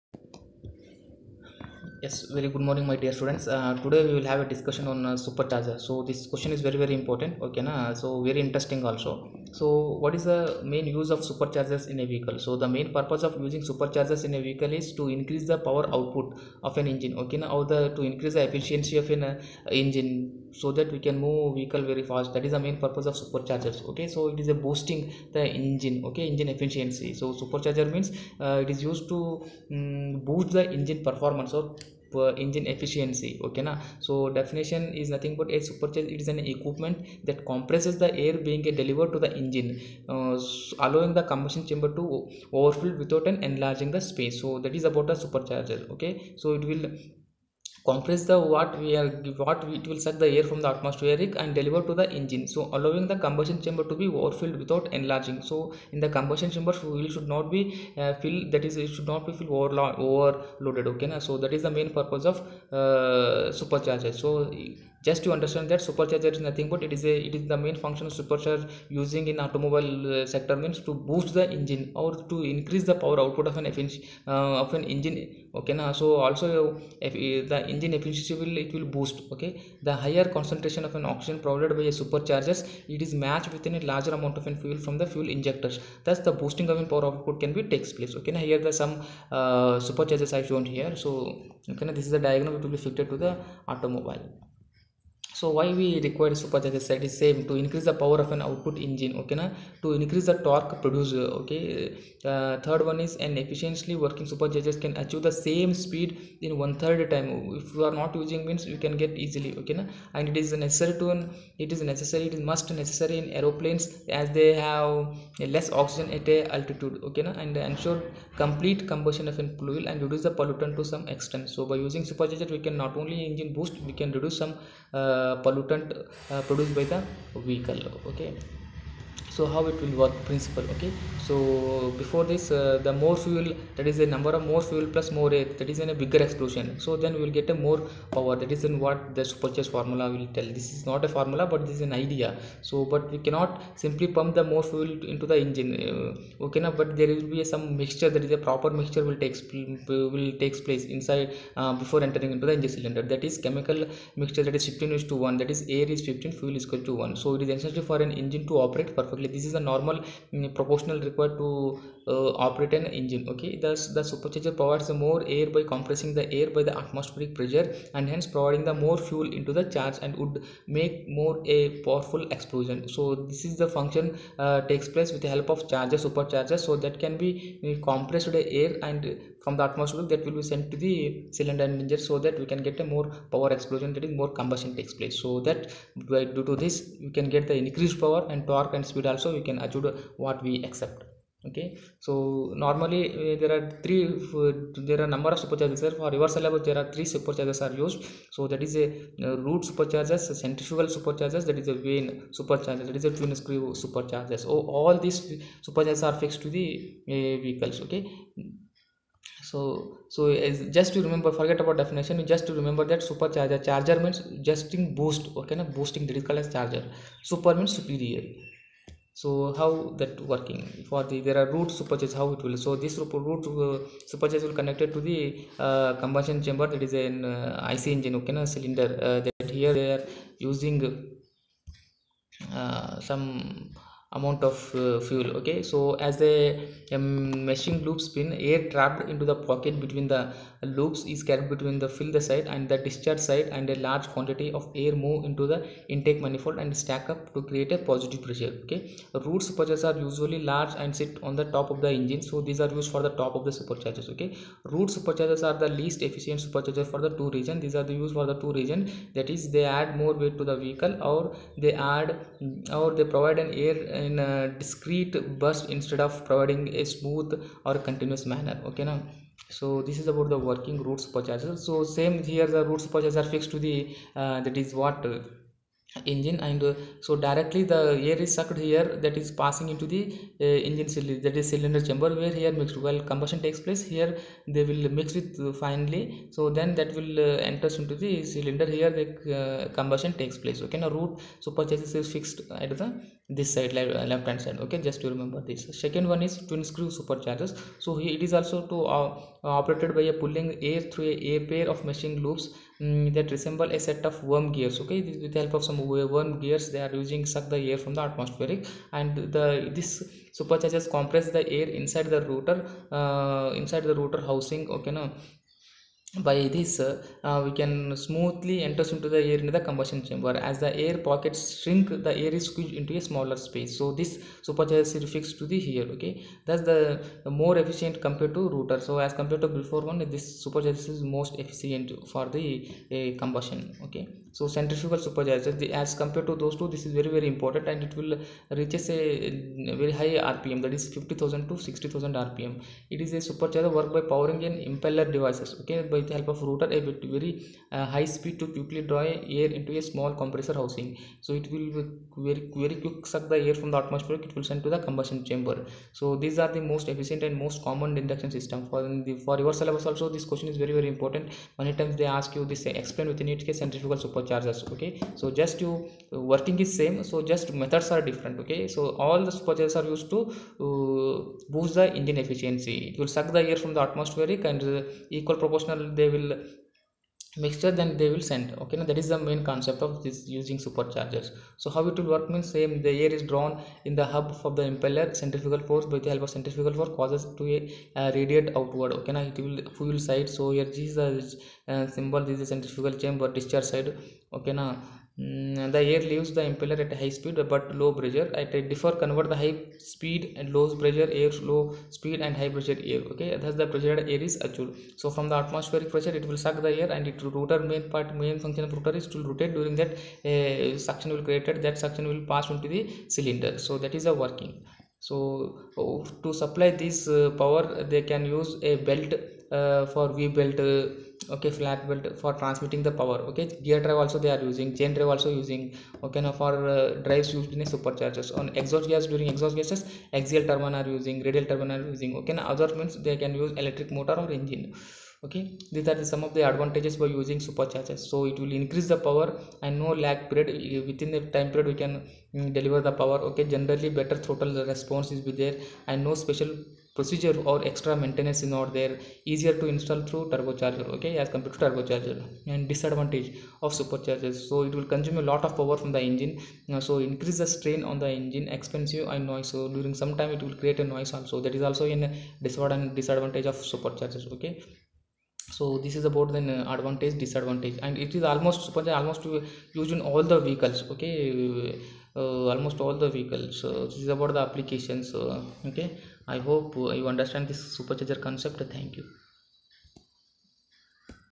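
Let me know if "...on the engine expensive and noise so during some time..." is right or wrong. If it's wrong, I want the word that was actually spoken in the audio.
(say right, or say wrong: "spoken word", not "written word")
right.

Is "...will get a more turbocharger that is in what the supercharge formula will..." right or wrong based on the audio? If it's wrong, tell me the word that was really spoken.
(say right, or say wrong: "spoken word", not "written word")
wrong: "power", not "turbocharger".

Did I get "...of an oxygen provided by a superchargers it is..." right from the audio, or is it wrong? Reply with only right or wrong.
right.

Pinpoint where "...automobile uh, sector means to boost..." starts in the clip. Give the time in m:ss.
1:09.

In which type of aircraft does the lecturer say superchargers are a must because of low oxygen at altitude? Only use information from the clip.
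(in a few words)
aeroplanes.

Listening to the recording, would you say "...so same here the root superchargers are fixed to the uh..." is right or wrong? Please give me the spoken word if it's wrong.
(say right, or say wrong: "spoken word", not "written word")
right.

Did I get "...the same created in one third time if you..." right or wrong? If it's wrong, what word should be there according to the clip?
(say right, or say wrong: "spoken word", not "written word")
wrong: "speed", not "created".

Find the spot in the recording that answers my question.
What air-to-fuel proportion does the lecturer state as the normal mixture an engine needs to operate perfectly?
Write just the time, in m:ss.
2:34.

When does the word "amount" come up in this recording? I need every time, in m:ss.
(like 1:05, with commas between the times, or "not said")
1:24, 3:54.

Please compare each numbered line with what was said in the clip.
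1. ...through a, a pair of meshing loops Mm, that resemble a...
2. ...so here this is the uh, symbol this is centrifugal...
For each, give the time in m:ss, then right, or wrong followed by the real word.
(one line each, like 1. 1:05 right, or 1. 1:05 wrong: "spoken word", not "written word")
1. 5:00 right
2. 6:30 right.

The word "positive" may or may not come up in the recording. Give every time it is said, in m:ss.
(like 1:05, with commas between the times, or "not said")
4:07.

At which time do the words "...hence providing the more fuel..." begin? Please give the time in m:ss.
2:48.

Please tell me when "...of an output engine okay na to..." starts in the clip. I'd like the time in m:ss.
1:38.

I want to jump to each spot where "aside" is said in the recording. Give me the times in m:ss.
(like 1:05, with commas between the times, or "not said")
not said.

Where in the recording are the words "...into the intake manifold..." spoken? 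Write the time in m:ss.
4:05.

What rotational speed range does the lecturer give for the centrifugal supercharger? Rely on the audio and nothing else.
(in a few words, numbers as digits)
50000 to 60000 rpm.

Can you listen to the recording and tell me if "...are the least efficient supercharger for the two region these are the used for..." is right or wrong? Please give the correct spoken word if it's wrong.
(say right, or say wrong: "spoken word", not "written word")
right.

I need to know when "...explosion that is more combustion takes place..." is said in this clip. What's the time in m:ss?
3:03.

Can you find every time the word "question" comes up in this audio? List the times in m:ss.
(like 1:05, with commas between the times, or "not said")
0:06, 6:00.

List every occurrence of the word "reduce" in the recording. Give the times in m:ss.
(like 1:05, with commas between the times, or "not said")
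2:00, 2:04.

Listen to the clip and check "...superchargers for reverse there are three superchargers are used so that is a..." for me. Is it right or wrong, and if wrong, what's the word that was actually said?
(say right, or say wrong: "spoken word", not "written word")
right.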